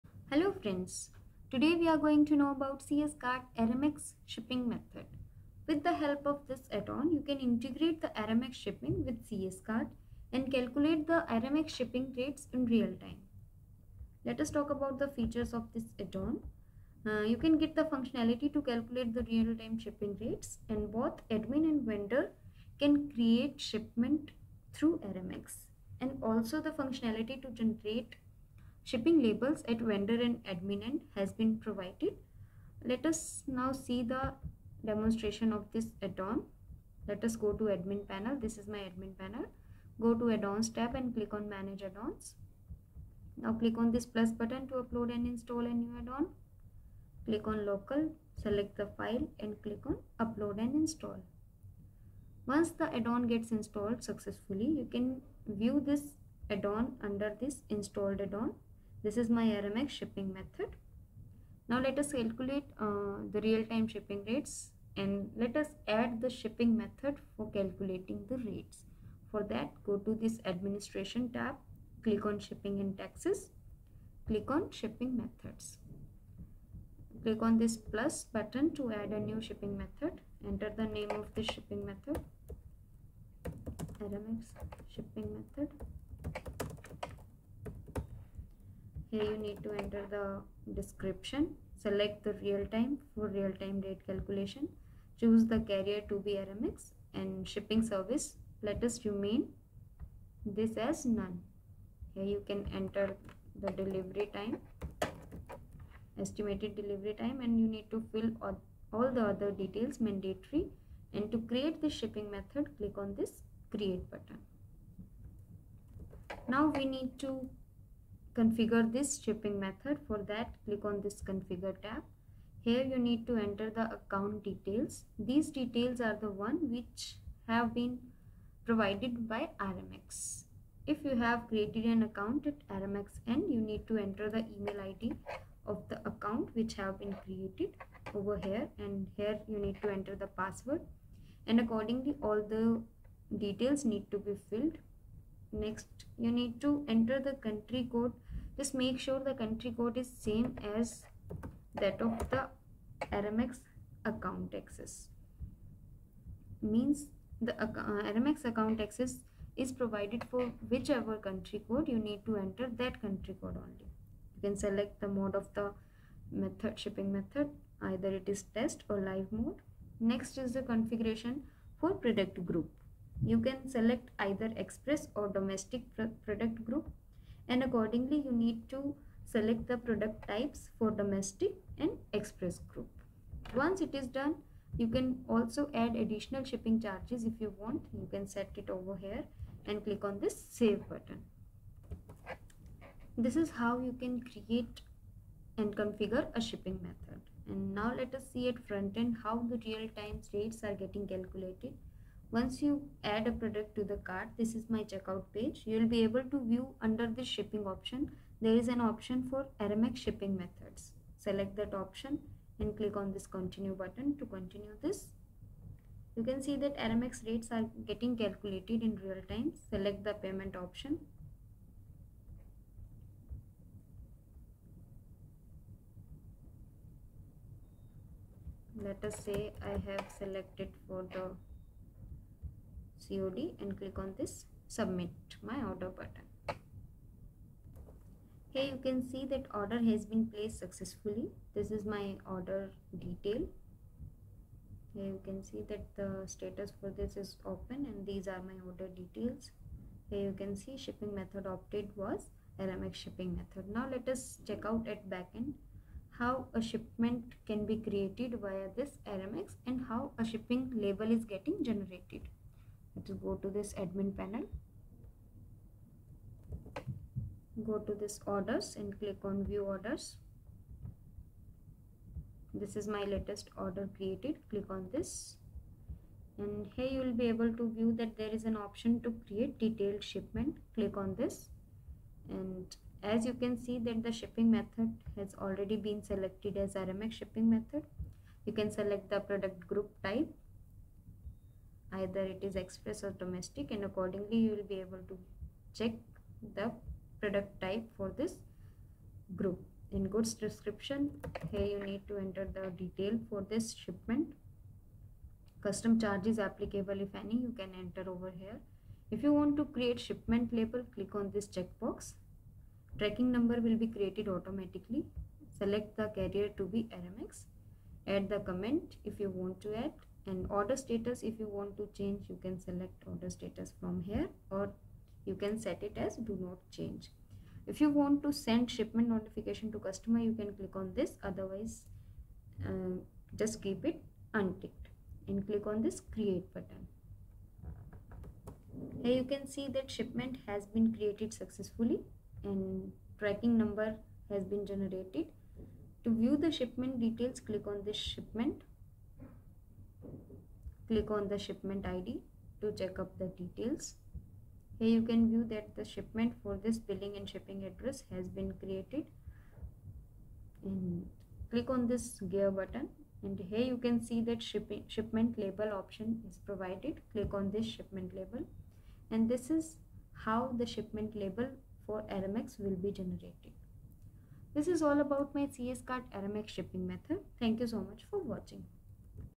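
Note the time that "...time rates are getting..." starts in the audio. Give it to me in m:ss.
3:19.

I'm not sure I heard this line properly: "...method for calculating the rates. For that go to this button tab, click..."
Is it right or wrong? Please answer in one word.
wrong.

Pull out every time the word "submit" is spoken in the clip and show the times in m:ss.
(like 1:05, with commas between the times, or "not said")
3:54.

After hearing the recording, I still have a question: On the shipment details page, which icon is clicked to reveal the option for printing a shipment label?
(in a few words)
Gear button.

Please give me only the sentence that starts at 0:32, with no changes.
Let us now see the demonstration of this add-on.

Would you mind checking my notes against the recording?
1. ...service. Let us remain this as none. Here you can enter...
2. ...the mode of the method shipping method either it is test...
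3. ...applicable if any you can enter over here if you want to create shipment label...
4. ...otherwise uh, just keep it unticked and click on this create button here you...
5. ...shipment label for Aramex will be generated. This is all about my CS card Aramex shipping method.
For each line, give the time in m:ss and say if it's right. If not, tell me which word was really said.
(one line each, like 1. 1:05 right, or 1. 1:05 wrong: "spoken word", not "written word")
1. 1:37 right
2. 2:45 right
3. 5:06 right
4. 5:31 right
5. 6:10 right.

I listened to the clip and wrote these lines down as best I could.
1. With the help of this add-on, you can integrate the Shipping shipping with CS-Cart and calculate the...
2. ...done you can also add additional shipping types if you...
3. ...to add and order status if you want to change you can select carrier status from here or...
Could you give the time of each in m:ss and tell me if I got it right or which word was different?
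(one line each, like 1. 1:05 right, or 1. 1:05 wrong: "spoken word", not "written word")
1. 0:05 wrong: "Aramex", not "Shipping"
2. 3:04 wrong: "charges", not "types"
3. 5:19 wrong: "order", not "carrier".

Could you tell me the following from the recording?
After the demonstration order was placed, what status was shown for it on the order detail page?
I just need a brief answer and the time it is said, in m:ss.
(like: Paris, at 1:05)
Open, at 4:07.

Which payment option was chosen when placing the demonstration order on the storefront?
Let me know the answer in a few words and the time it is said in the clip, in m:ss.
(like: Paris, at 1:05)
COD, at 3:53.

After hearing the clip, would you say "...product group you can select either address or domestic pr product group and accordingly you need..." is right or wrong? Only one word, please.
wrong.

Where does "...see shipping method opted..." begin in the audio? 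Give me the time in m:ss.
4:10.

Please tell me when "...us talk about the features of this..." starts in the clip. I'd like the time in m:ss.
0:14.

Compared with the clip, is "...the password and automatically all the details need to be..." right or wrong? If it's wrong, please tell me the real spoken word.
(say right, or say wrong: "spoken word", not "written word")
wrong: "accordingly", not "automatically".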